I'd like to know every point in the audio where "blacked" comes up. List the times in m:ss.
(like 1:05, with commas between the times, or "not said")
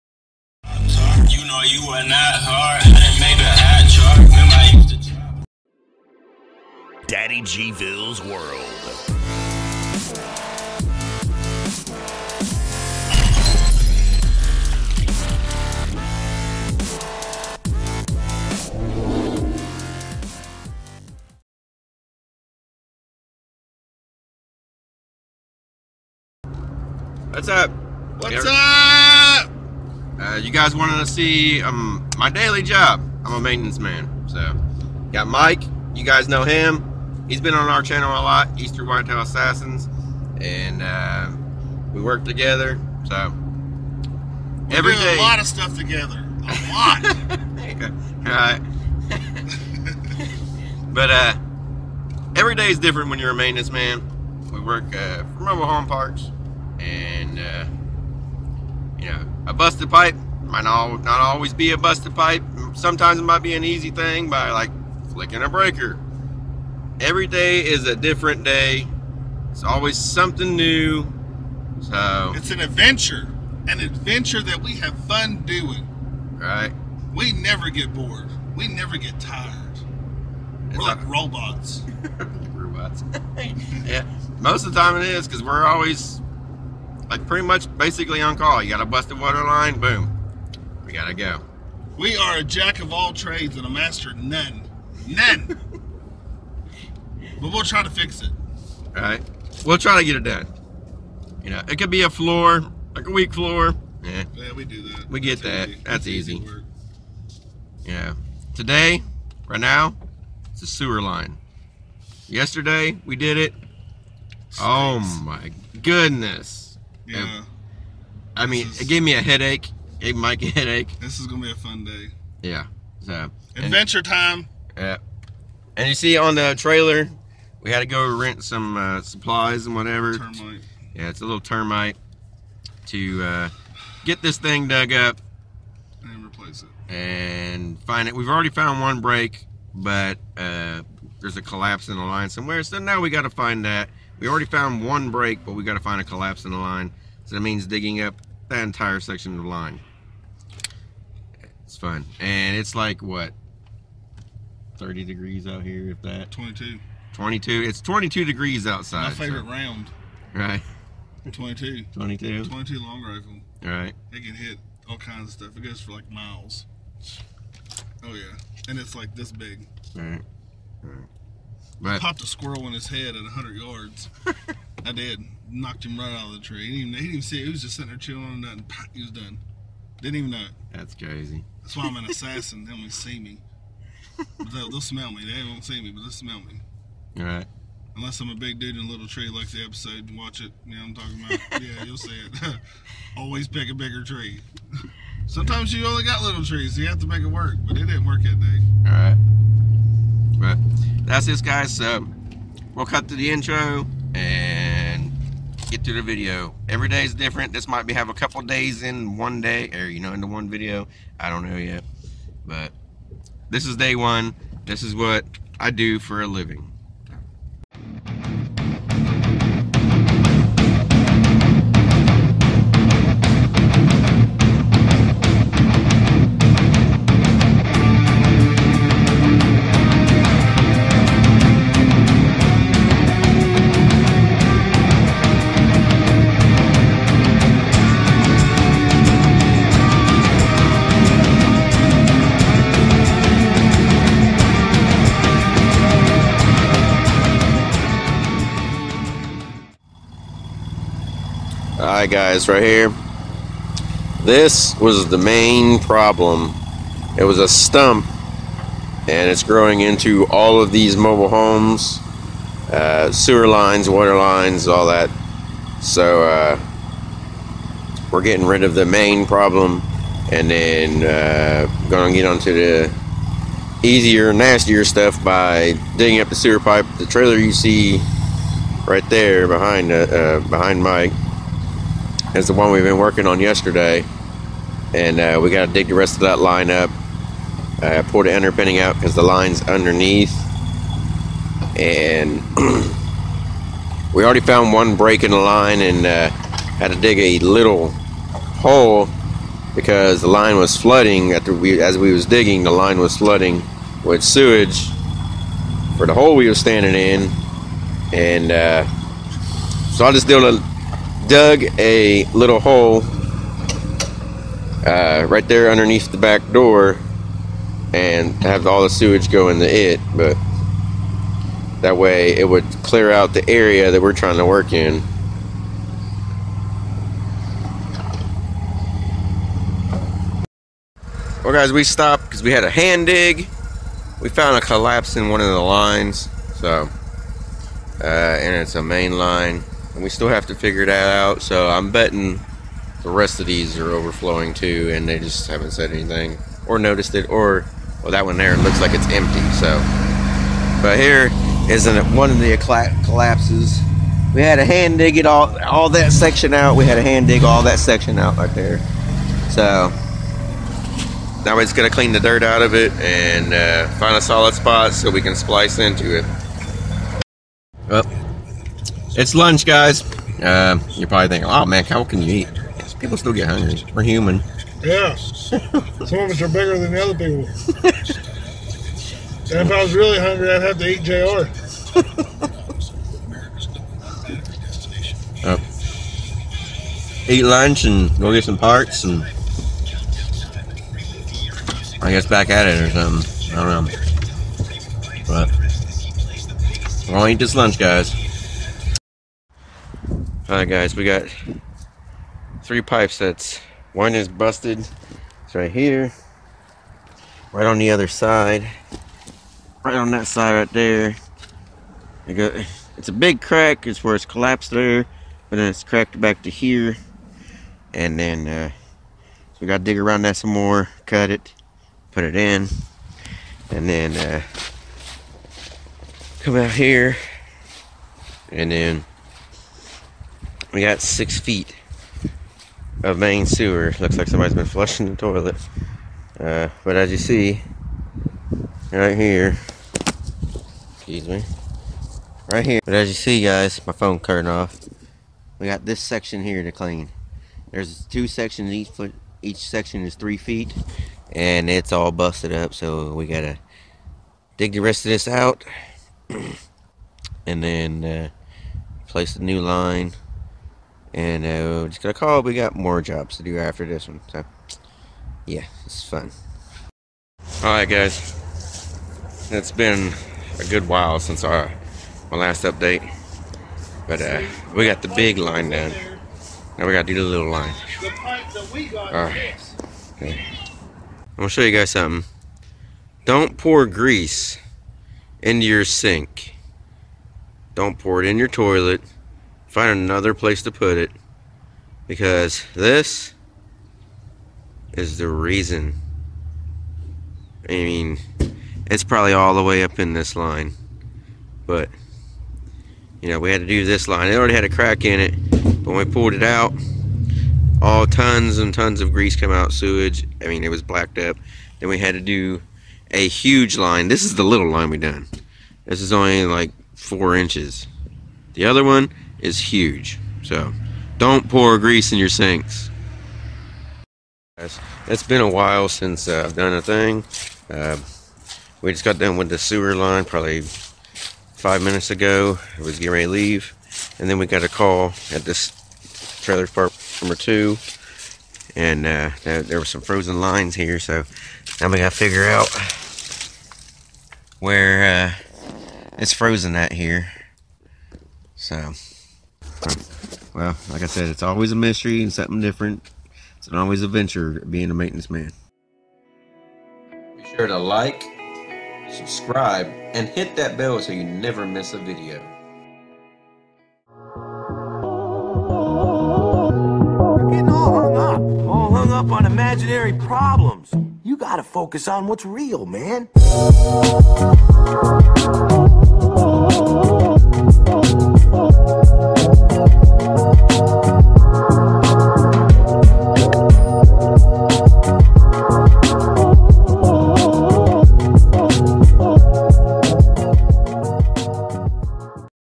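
8:30.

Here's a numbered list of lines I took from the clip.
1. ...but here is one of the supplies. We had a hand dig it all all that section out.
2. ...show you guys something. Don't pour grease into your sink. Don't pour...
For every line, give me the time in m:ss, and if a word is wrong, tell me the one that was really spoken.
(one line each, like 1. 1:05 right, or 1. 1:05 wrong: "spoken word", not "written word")
1. 5:50 wrong: "collapses", not "supplies"
2. 8:01 right.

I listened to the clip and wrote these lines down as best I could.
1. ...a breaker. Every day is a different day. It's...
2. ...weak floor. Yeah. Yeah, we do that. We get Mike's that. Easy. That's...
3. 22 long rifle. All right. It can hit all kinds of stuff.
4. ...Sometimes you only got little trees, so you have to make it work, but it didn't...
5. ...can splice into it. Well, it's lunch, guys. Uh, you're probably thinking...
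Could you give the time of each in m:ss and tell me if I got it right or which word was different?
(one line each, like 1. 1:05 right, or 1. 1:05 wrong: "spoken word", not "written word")
1. 1:05 right
2. 1:43 wrong: "That", not "Mike"
3. 2:42 right
4. 3:15 right
5. 6:05 right.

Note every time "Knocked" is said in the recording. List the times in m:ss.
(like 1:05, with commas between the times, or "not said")
2:55.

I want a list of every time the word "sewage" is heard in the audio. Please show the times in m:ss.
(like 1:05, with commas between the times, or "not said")
5:04, 5:18, 8:29.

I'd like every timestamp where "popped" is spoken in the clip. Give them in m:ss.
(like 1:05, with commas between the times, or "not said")
2:52.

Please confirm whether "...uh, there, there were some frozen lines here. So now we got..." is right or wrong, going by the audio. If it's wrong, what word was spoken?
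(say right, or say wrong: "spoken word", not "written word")
right.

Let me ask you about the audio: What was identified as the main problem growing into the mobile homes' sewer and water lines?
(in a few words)
A stump.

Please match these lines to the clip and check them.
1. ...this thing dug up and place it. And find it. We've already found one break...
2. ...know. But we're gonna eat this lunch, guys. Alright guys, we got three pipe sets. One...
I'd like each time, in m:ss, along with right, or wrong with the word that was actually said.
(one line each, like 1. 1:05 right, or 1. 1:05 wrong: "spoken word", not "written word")
1. 2:14 wrong: "replace", not "place"
2. 6:33 right.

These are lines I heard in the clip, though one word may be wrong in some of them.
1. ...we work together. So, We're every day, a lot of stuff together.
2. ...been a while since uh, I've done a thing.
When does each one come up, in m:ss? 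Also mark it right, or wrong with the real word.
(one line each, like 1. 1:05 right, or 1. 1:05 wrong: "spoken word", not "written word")
1. 0:41 right
2. 8:45 right.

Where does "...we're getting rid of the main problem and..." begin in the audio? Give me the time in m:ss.
4:28.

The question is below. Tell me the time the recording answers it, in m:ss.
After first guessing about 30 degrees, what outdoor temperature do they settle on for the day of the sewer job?
2:37.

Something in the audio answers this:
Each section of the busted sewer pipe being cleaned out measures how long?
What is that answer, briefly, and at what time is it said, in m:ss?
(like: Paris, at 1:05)
3 feet, at 7:30.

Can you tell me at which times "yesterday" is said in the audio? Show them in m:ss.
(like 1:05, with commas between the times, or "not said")
1:52, 4:43.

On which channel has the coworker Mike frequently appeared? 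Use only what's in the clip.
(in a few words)
Easter Whitetail Assassins.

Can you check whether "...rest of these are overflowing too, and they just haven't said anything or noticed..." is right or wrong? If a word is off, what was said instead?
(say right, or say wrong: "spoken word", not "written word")
right.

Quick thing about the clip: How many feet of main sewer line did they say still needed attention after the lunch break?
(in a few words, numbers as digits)
6 feet.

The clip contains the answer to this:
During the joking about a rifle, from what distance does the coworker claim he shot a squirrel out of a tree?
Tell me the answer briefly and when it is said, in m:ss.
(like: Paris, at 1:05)
100 yards, at 2:53.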